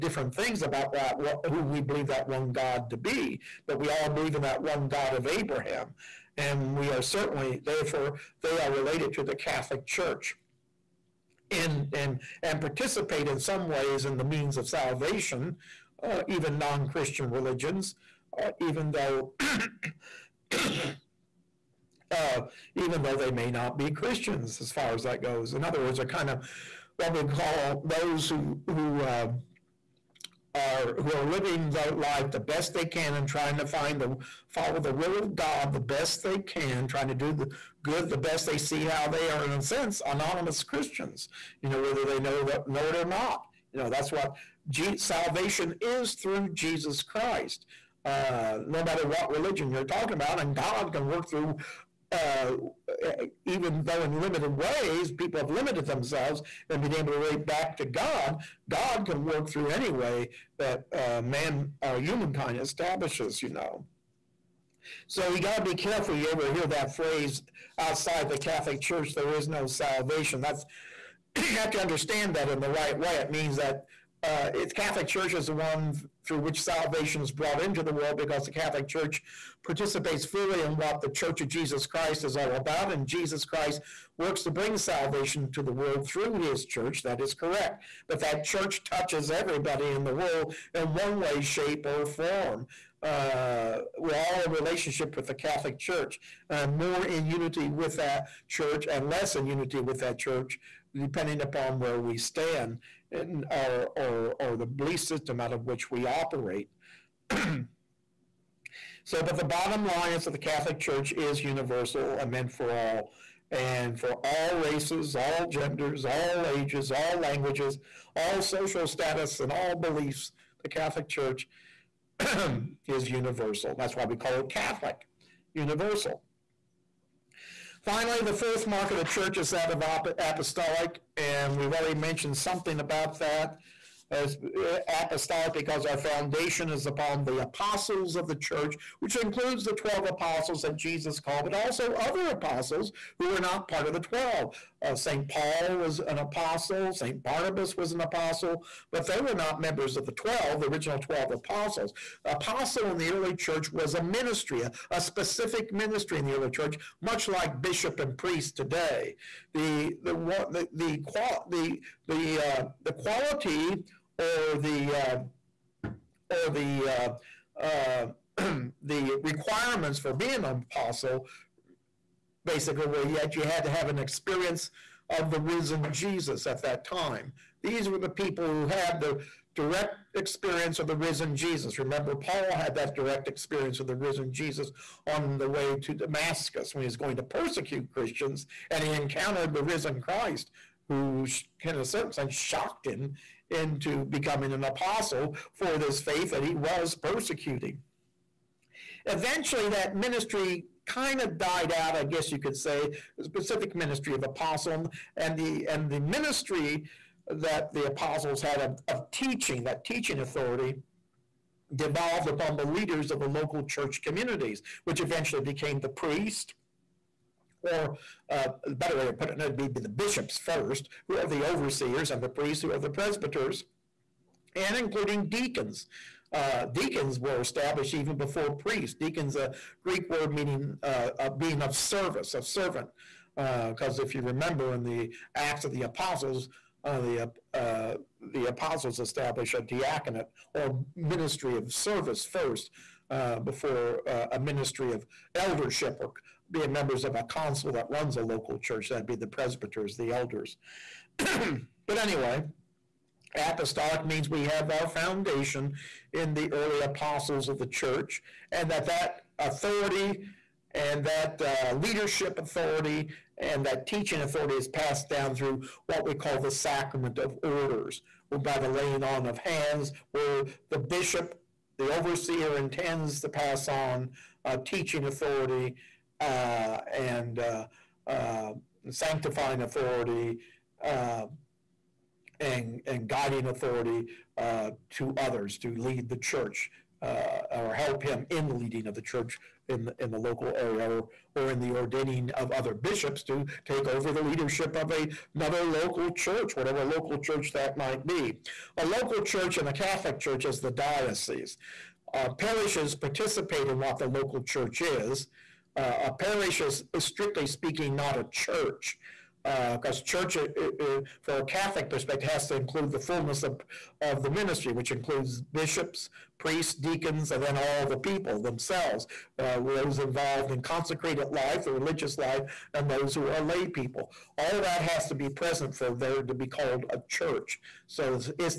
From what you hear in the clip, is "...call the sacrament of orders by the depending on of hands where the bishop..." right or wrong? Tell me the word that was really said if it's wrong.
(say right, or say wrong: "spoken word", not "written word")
wrong: "laying", not "depending".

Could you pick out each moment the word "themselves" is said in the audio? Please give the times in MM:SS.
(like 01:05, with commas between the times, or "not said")
00:55, 05:18.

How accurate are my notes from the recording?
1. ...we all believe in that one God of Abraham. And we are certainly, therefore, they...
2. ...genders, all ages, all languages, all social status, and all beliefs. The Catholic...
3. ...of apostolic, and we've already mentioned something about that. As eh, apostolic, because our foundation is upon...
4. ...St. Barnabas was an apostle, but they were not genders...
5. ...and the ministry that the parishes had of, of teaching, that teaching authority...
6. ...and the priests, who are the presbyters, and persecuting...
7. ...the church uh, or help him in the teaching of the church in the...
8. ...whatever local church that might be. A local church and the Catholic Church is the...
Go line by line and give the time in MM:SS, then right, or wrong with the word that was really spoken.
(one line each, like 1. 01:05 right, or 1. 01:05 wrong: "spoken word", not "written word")
1. 00:03 right
2. 01:55 right
3. 02:09 right
4. 02:26 wrong: "members", not "genders"
5. 03:25 wrong: "apostles", not "parishes"
6. 03:42 wrong: "including", not "persecuting"
7. 04:46 wrong: "leading", not "teaching"
8. 04:56 right.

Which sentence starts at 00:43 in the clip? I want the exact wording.
You know that's what G- salvation is through Jesus Christ.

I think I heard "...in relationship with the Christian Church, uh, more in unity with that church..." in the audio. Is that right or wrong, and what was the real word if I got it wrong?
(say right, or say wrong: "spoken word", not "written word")
wrong: "Catholic", not "Christian".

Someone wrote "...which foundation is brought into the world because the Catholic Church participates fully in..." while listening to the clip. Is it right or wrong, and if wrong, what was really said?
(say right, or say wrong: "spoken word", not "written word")
wrong: "salvation", not "foundation".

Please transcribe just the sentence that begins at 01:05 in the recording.
So you got to be careful you ever hear that phrase outside the Catholic Church, there is no salvation.